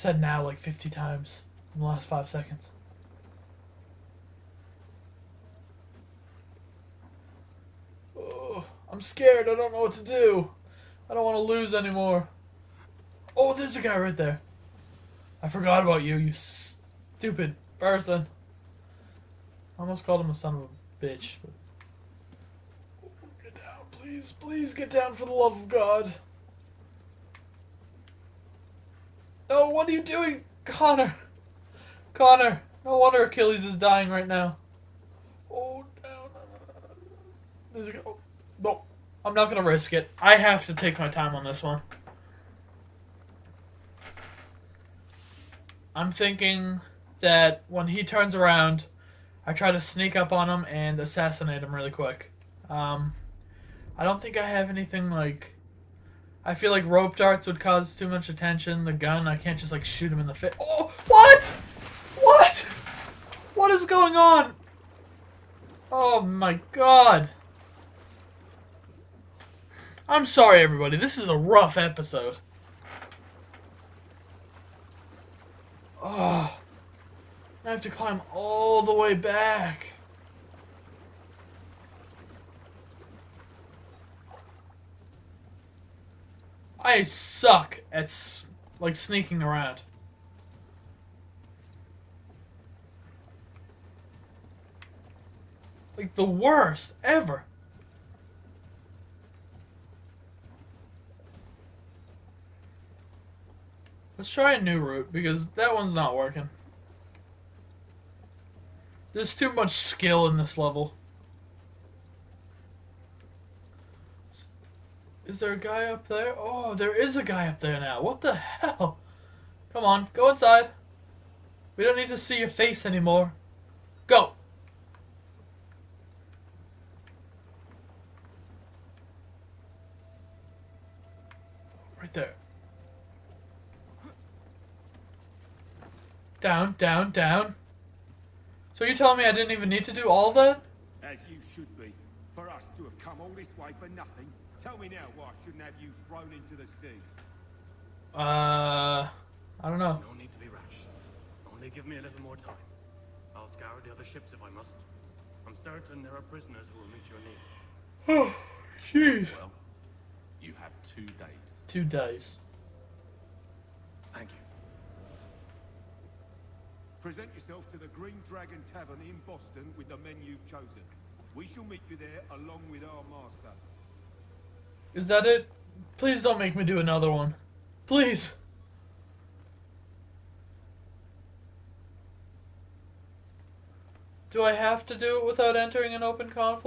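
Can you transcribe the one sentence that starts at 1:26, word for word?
I suck at, like, sneaking around.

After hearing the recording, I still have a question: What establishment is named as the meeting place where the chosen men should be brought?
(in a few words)
Green Dragon Tavern.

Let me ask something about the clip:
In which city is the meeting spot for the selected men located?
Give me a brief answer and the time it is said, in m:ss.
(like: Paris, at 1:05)
Boston, at 2:49.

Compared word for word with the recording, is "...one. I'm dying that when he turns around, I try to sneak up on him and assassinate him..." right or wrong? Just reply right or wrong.
wrong.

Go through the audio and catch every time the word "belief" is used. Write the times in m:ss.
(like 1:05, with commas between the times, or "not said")
not said.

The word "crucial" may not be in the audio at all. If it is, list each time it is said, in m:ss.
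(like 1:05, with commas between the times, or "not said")
not said.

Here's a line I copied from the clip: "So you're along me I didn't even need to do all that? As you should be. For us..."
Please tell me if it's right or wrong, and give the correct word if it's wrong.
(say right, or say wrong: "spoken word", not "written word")
wrong: "telling", not "along".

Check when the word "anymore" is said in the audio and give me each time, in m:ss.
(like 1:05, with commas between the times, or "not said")
0:11, 2:02.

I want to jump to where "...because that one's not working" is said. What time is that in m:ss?
1:45.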